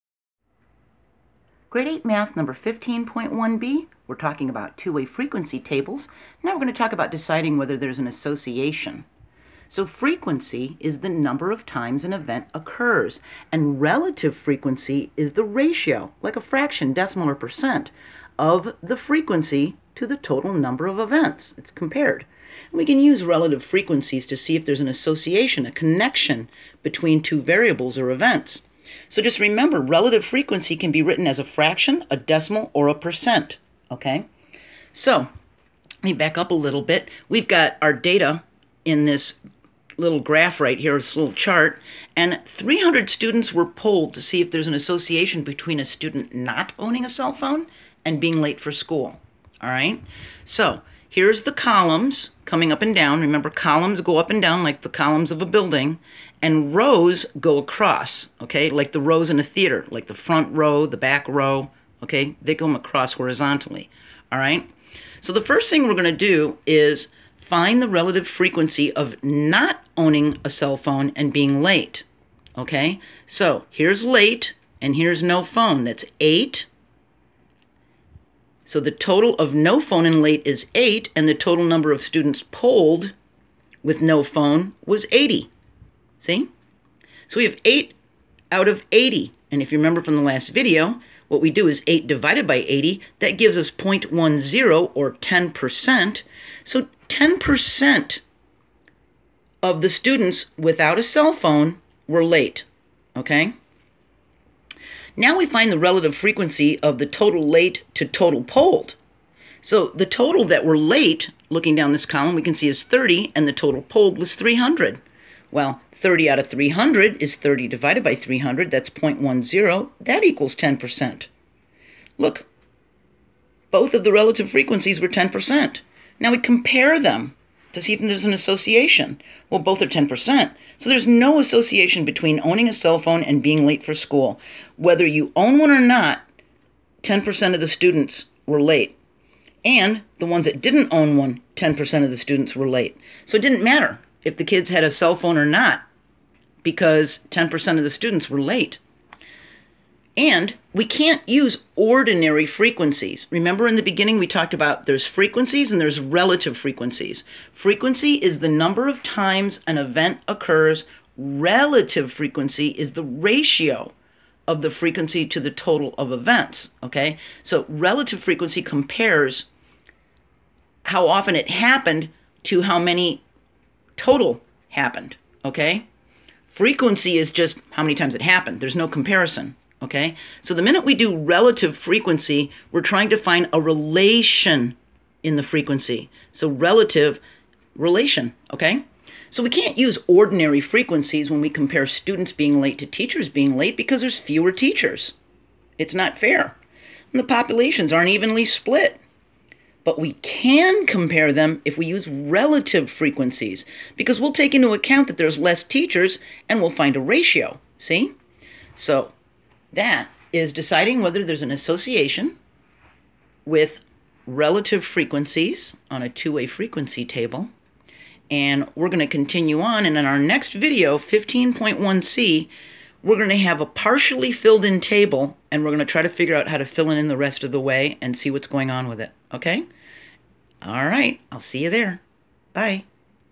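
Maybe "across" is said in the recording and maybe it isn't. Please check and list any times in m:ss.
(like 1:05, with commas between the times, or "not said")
0:57, 1:02.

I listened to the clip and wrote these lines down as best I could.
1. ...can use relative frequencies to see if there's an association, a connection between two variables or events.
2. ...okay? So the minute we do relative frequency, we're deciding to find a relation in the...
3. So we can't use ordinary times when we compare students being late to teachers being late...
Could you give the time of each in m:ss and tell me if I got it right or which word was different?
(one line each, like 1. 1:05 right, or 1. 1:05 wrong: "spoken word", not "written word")
1. 0:22 right
2. 2:59 wrong: "trying", not "deciding"
3. 3:09 wrong: "frequencies", not "times".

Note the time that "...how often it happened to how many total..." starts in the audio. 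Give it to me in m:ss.
2:50.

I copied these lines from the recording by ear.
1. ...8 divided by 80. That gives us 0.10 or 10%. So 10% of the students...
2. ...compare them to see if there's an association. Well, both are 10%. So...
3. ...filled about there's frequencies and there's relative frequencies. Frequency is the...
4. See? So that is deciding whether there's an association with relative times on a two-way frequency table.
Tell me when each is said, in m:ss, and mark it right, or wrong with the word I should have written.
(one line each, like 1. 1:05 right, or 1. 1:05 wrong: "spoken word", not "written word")
1. 1:31 right
2. 2:06 right
3. 2:34 wrong: "talked", not "filled"
4. 3:27 wrong: "frequencies", not "times".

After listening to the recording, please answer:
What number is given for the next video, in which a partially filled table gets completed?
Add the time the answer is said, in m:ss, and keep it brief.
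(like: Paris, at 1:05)
15.1c, at 3:40.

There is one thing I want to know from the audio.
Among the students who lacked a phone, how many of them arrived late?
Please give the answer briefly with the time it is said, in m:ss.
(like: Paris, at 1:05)
8, at 1:18.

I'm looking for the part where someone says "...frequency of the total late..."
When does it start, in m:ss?
1:46.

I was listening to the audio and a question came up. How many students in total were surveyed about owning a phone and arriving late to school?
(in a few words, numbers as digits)
300.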